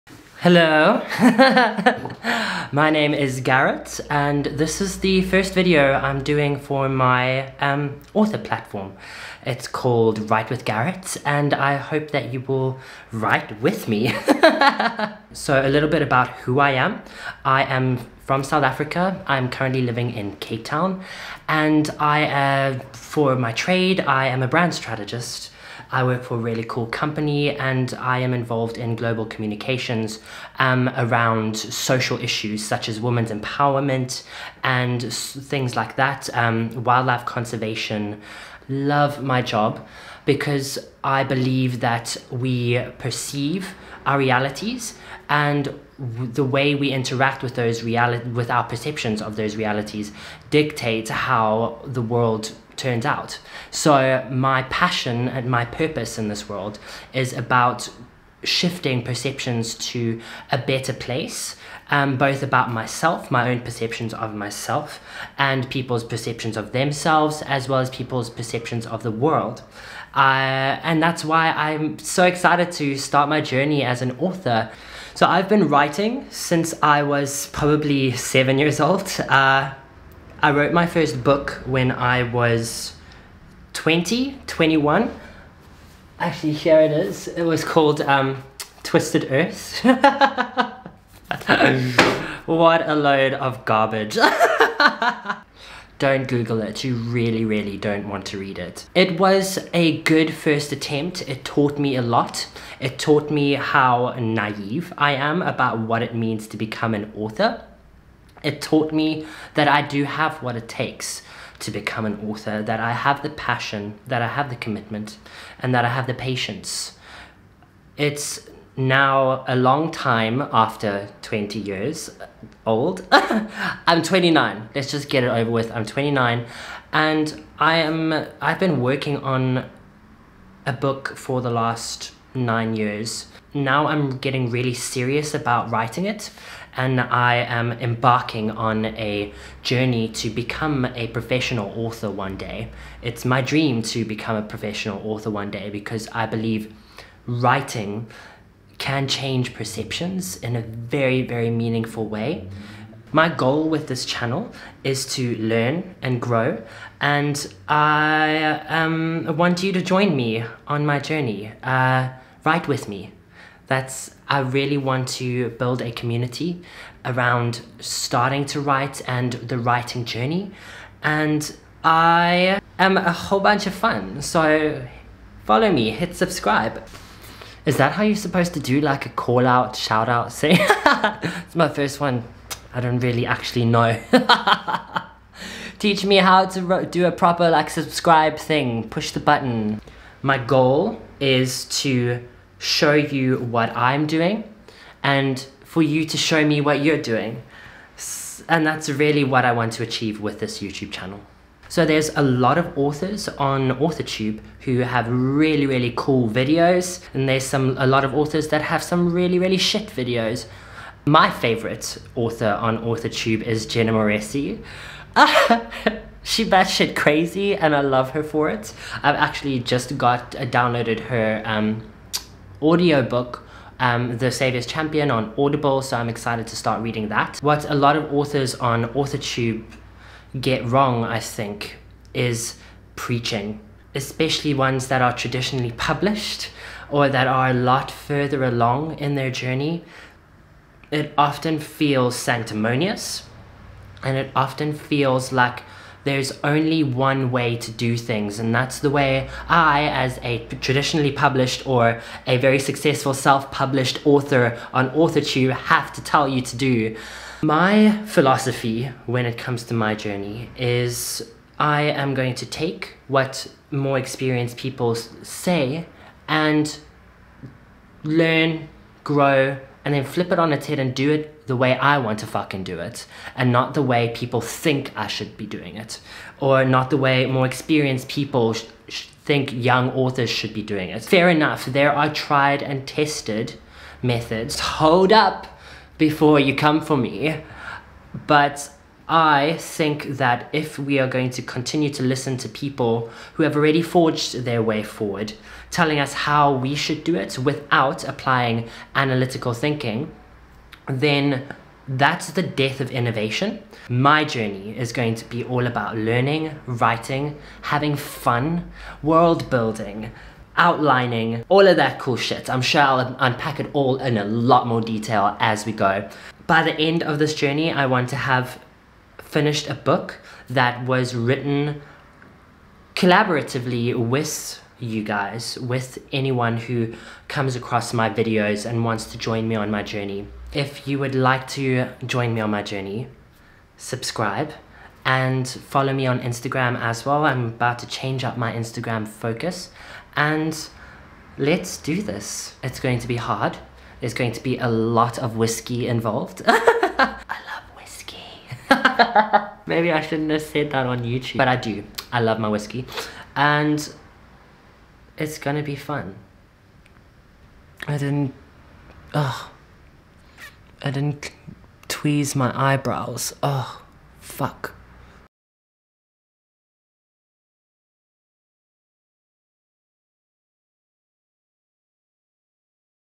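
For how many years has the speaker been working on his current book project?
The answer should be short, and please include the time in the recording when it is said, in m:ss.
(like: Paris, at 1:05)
9, at 2:12.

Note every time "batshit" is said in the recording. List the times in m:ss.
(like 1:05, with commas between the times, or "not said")
3:36.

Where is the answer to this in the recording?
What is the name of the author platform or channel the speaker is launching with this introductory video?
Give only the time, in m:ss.
0:10.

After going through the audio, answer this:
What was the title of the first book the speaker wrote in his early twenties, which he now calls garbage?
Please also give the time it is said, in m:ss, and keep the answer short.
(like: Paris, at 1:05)
Twisted Earth, at 1:28.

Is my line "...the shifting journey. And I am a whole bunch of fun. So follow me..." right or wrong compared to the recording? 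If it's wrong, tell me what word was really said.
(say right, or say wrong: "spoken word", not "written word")
wrong: "writing", not "shifting".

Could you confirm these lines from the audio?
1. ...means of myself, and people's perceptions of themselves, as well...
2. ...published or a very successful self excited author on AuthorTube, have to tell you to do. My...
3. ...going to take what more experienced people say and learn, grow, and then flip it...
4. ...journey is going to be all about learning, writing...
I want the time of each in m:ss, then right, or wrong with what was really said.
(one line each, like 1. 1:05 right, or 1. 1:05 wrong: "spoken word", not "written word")
1. 1:03 wrong: "perceptions", not "means"
2. 4:11 wrong: "published", not "excited"
3. 4:22 right
4. 5:04 right.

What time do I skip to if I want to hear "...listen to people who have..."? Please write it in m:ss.
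4:52.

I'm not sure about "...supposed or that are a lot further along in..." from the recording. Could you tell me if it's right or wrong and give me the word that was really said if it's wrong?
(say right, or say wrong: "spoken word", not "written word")
wrong: "published", not "supposed".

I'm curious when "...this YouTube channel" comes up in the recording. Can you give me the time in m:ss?
3:20.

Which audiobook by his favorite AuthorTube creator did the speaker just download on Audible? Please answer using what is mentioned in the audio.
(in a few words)
The Saviour's Champion.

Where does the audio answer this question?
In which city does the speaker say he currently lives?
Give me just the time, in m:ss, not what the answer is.
0:20.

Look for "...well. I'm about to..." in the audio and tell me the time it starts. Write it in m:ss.
5:37.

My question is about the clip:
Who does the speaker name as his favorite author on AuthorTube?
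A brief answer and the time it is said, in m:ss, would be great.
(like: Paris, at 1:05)
Jenna Moreci, at 3:33.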